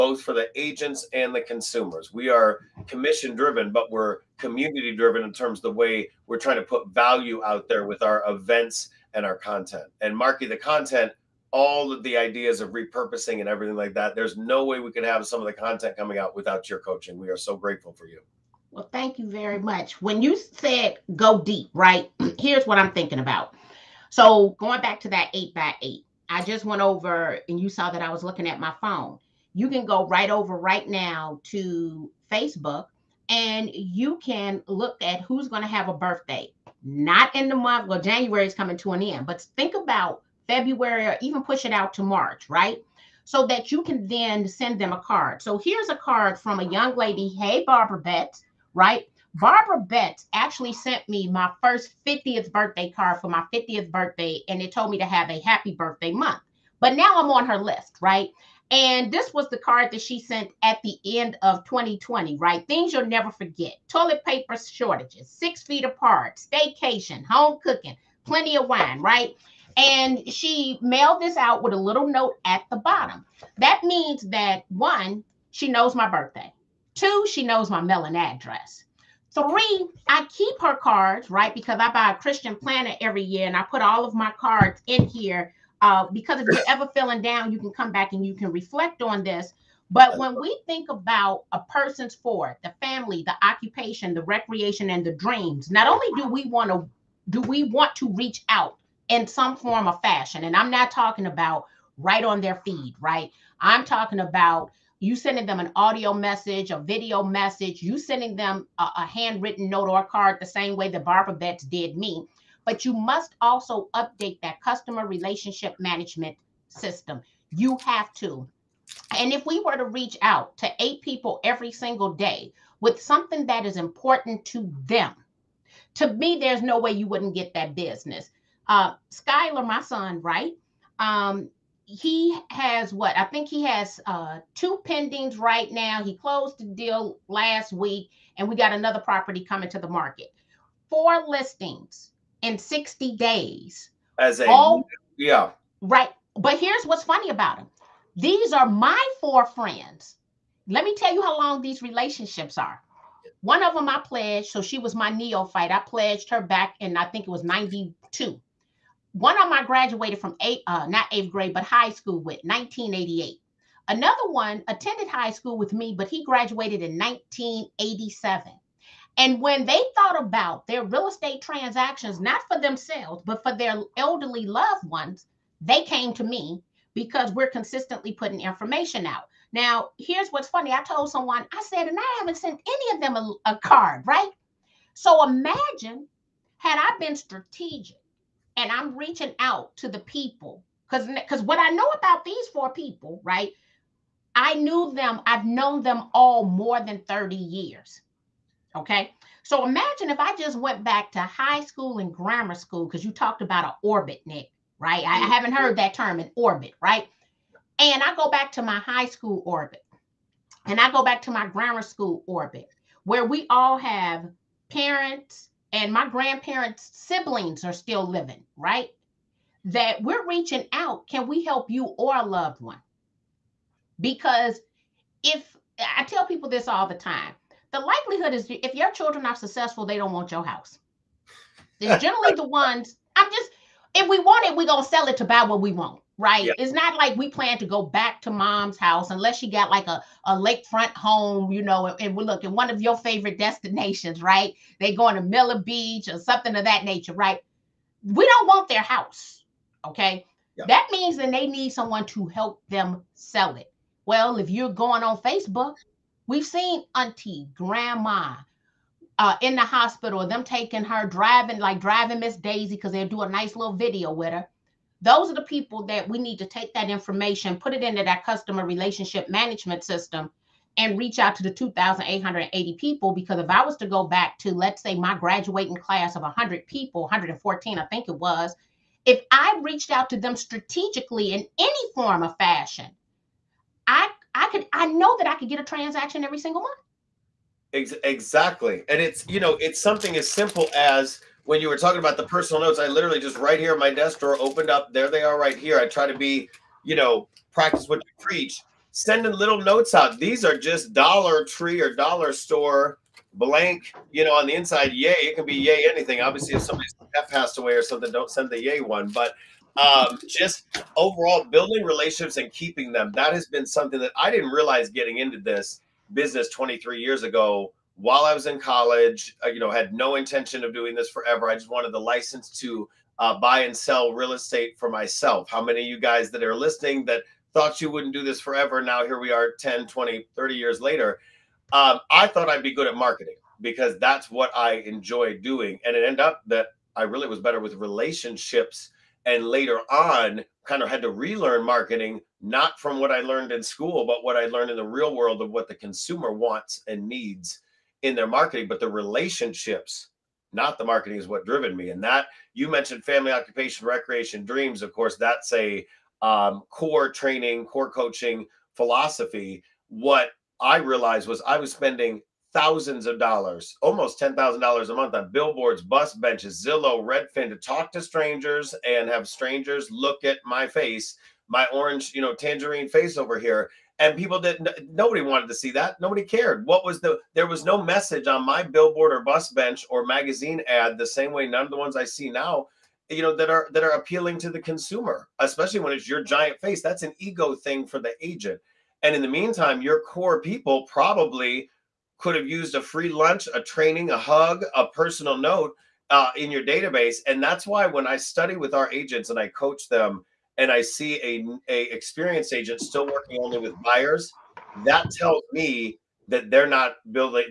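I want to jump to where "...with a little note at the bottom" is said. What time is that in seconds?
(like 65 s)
71 s.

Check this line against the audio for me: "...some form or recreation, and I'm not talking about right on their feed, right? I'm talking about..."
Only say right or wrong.
wrong.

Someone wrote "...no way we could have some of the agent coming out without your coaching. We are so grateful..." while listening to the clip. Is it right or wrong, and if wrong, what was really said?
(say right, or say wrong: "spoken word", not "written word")
wrong: "content", not "agent".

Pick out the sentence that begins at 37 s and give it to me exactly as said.
Well, January is coming to an end, but think about February or even push it out to March, right?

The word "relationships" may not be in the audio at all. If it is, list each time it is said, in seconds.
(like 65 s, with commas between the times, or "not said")
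115 s, 151 s, 268 s, 311 s, 337 s, 348 s.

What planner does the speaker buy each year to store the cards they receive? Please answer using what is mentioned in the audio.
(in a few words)
Christian planner.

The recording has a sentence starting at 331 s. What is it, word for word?
Um, I thought I'd be good at marketing because that's what I enjoy doing.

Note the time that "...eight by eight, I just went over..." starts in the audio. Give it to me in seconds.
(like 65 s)
25 s.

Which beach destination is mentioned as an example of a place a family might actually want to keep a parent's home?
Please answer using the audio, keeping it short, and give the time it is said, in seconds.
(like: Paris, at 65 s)
Miller Beach, at 245 s.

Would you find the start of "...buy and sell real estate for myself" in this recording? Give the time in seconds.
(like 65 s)
323 s.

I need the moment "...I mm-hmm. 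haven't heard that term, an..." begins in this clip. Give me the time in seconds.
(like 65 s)
205 s.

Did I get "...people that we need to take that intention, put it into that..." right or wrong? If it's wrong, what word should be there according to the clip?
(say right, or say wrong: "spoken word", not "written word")
wrong: "information", not "intention".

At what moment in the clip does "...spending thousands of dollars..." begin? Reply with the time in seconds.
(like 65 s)
361 s.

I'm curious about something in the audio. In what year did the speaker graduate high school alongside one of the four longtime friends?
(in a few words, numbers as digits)
1988.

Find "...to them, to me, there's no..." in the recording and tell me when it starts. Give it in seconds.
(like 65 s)
124 s.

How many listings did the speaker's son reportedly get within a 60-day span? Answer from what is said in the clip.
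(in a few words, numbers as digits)
4.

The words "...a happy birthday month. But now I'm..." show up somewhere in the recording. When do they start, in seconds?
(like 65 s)
55 s.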